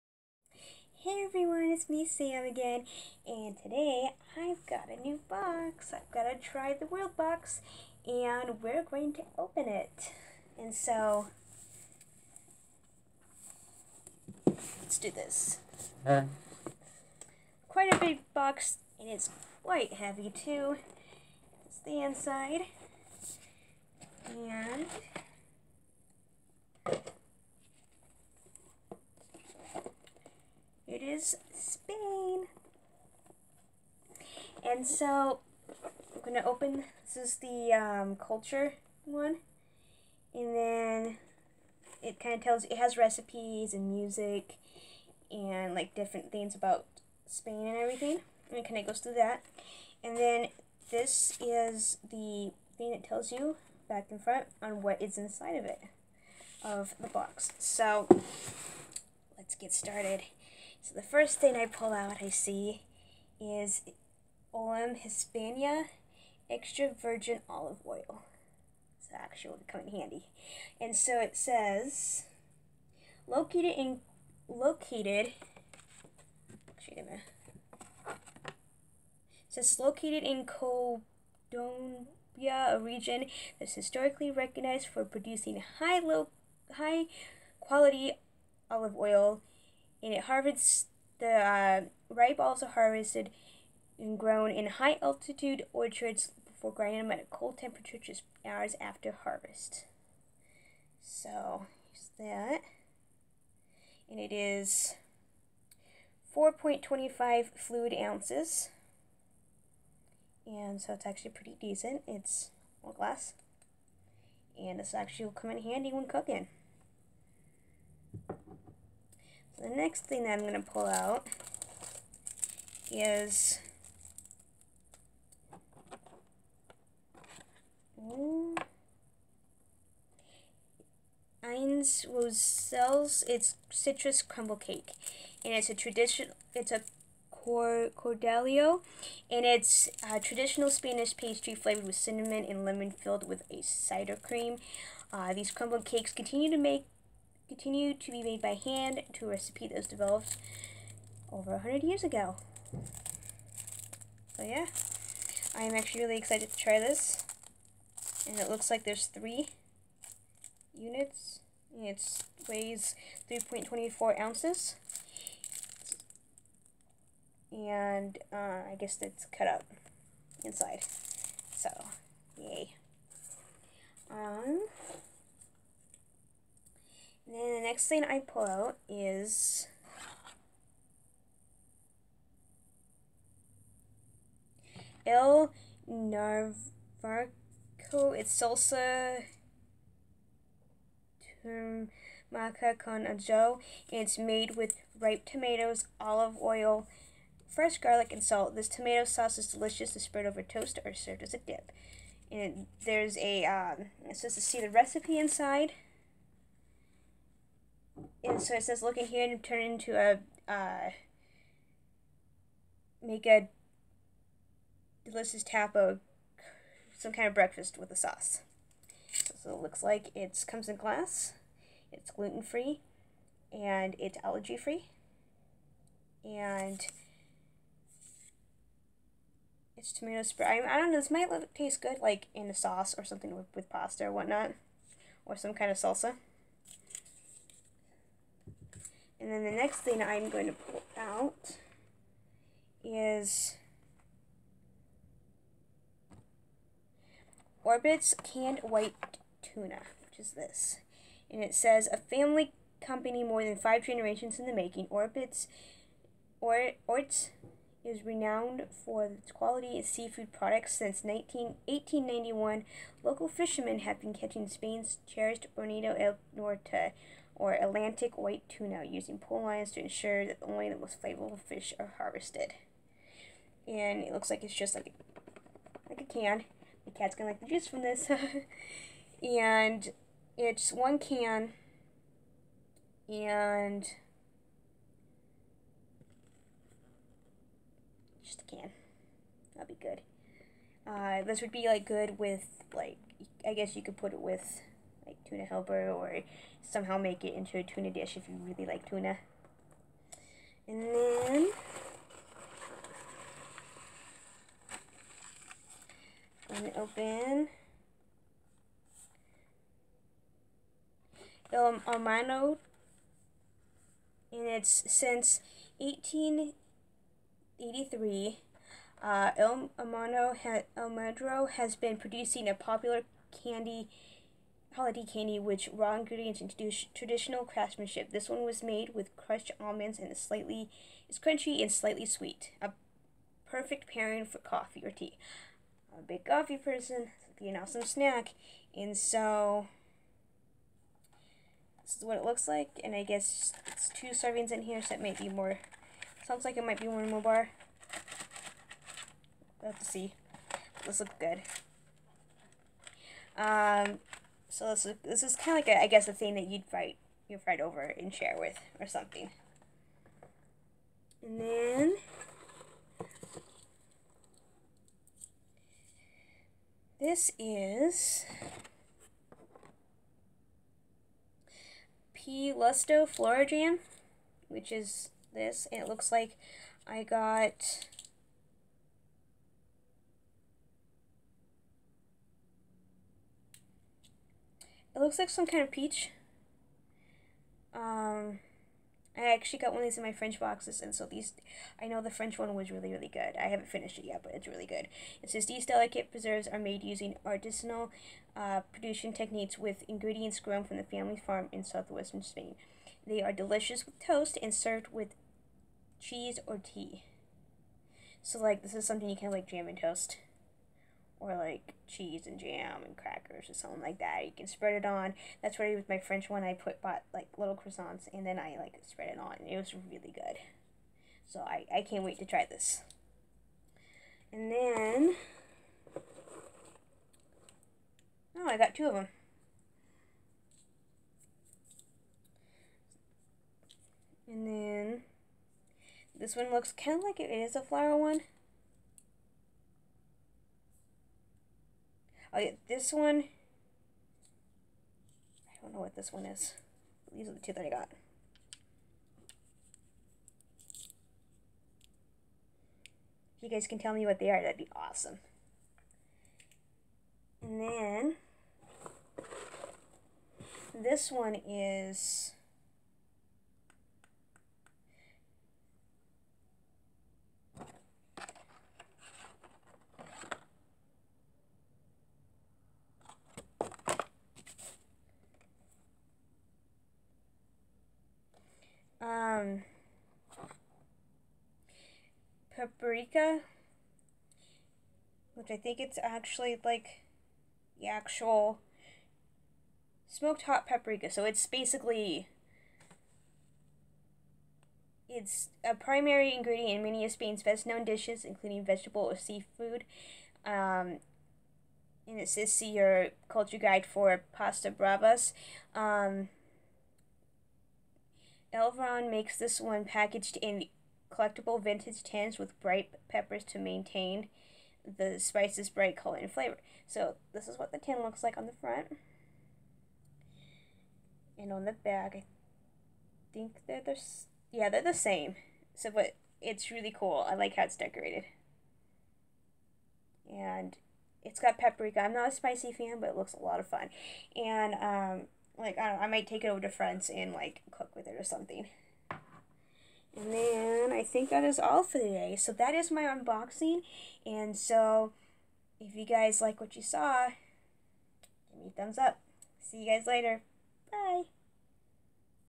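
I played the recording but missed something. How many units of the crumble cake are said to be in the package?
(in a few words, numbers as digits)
3.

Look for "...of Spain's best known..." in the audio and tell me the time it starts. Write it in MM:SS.
08:17.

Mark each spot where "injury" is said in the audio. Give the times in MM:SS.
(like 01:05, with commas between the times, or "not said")
not said.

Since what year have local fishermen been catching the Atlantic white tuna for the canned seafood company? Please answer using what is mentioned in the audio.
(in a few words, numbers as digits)
1891.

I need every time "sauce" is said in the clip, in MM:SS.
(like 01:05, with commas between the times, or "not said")
03:19, 03:37, 03:52.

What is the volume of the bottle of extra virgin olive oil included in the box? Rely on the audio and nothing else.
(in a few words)
4.25 fluid ounces.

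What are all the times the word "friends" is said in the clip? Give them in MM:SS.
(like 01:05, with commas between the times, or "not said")
08:56.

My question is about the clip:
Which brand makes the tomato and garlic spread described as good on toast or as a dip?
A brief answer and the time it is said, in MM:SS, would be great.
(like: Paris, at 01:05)
El Navarrico, at 03:05.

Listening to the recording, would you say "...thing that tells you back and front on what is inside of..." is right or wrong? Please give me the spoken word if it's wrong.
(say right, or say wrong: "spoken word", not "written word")
right.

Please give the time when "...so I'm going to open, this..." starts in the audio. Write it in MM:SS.
00:34.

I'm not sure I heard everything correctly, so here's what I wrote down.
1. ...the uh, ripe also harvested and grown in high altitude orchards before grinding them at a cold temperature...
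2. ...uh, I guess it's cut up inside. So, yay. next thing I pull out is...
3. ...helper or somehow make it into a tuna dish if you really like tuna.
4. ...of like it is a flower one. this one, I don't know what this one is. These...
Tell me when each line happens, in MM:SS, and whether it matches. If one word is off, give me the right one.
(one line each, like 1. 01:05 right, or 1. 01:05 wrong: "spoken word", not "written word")
1. 01:31 right
2. 02:48 right
3. 04:55 right
4. 07:16 right.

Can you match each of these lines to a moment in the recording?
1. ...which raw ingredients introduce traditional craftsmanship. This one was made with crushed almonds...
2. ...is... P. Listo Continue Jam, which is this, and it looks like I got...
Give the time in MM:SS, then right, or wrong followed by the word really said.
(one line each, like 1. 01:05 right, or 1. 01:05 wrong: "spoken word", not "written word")
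1. 05:25 right
2. 06:07 wrong: "Flora", not "Continue".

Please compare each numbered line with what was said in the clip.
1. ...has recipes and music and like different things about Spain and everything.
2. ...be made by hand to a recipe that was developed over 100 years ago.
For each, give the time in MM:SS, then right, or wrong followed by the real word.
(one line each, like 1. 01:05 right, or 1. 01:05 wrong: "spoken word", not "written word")
1. 00:42 right
2. 02:28 right.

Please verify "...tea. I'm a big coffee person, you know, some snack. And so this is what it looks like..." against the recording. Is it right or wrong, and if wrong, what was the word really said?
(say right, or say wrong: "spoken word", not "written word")
right.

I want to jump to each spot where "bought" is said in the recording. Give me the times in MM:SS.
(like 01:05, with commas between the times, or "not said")
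06:56.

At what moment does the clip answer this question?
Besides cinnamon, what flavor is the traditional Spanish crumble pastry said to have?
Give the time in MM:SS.
02:22.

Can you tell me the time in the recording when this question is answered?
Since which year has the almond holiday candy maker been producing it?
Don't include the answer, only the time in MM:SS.
05:15.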